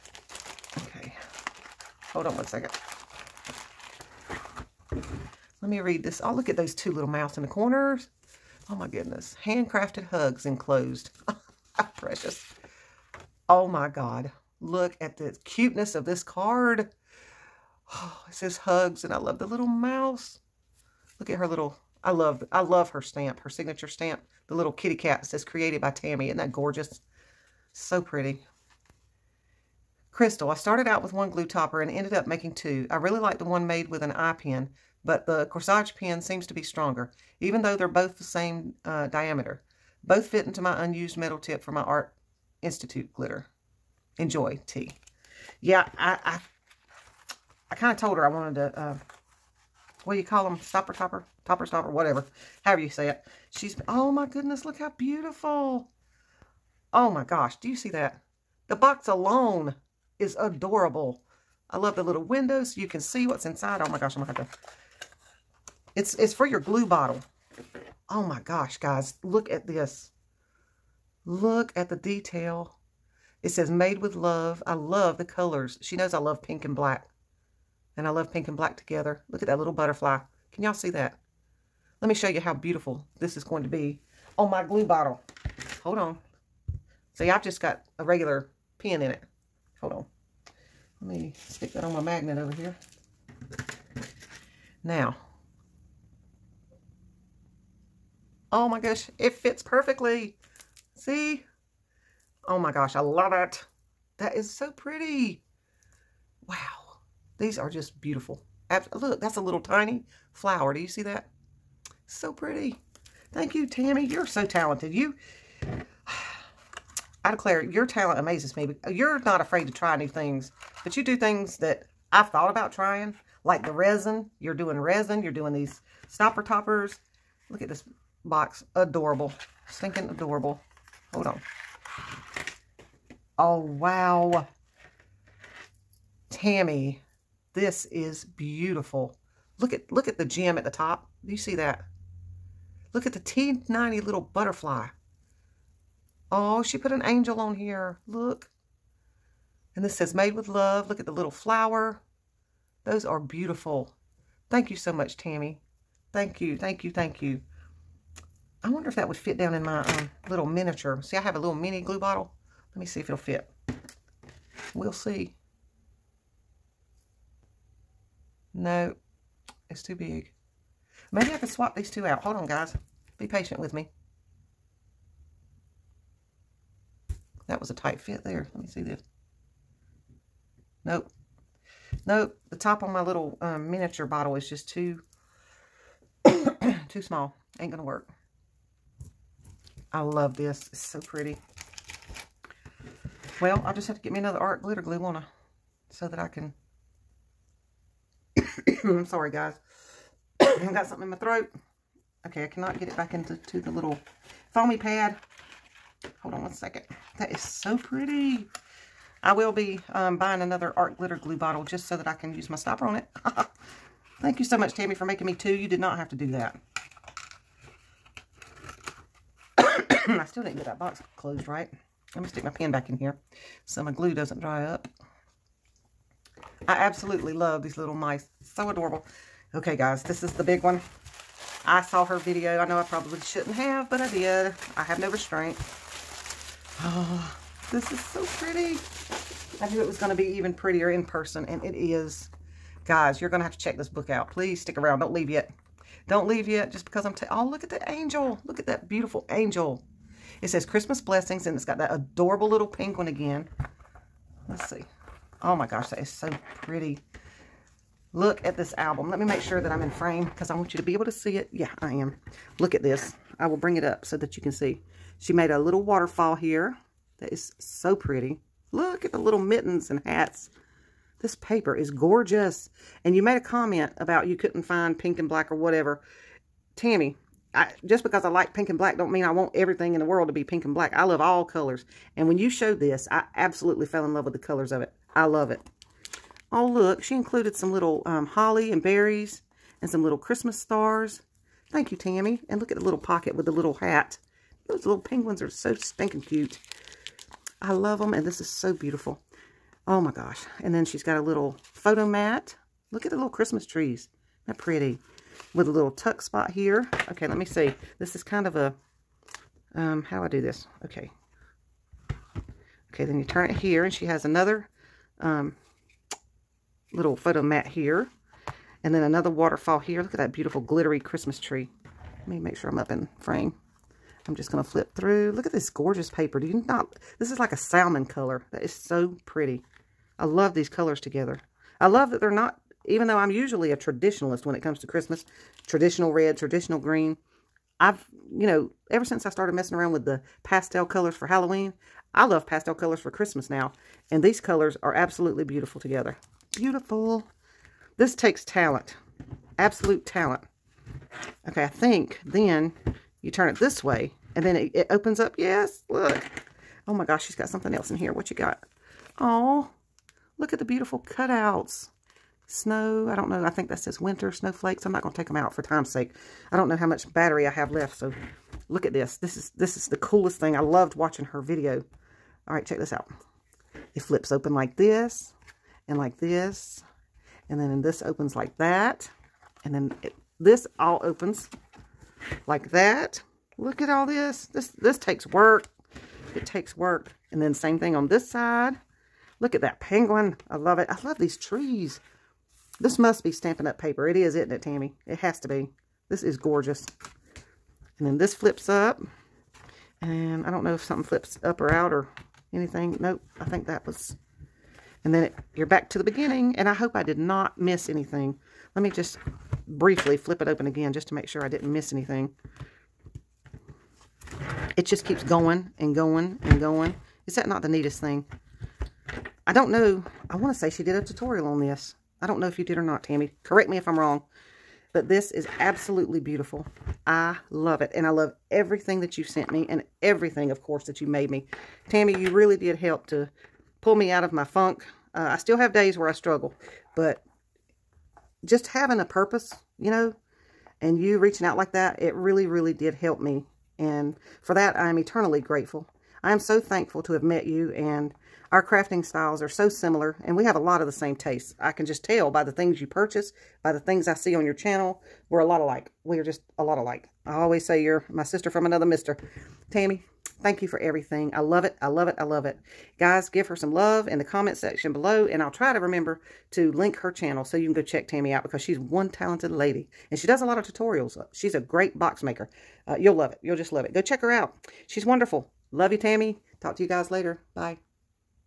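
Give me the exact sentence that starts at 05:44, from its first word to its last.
And these colors are absolutely beautiful together.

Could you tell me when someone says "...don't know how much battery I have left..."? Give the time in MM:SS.
06:06.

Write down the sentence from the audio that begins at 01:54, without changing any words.
You I declare, your talent amazes me.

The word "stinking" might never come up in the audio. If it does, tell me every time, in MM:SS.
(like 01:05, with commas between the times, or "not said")
02:09, 04:55.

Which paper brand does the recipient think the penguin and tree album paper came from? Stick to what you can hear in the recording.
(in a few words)
Stampin' Up.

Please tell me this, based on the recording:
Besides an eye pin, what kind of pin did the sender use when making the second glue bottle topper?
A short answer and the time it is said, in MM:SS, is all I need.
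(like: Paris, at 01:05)
corsage pin, at 00:35.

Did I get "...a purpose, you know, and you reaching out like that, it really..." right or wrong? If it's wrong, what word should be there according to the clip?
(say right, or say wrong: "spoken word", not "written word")
right.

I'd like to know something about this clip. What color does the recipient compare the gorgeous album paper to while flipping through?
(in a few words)
salmon.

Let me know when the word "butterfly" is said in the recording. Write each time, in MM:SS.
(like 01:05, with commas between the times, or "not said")
01:19, 02:24.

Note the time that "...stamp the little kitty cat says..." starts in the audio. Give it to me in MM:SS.
00:23.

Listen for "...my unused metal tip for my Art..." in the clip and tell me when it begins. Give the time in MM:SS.
00:40.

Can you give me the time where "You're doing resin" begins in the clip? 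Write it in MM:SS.
02:04.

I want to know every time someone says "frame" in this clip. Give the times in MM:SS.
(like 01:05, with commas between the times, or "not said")
04:19, 05:23.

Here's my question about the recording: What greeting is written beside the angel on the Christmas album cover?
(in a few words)
Christmas blessings.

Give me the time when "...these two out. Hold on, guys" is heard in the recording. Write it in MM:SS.
02:51.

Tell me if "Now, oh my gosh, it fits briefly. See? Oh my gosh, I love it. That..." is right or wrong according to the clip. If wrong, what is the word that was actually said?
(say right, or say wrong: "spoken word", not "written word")
wrong: "perfectly", not "briefly".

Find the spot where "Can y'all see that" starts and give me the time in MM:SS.
01:20.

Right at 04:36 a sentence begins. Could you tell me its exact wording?
Tami, I, just because I like pink and black don't mean I want everything in the world to be pink and black.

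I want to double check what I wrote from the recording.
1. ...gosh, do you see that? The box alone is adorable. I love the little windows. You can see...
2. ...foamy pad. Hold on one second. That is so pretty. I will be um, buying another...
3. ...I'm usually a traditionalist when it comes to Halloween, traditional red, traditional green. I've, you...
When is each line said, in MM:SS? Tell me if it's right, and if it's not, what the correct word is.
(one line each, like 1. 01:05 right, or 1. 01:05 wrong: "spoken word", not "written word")
1. 00:57 right
2. 03:24 right
3. 05:33 wrong: "Christmas", not "Halloween".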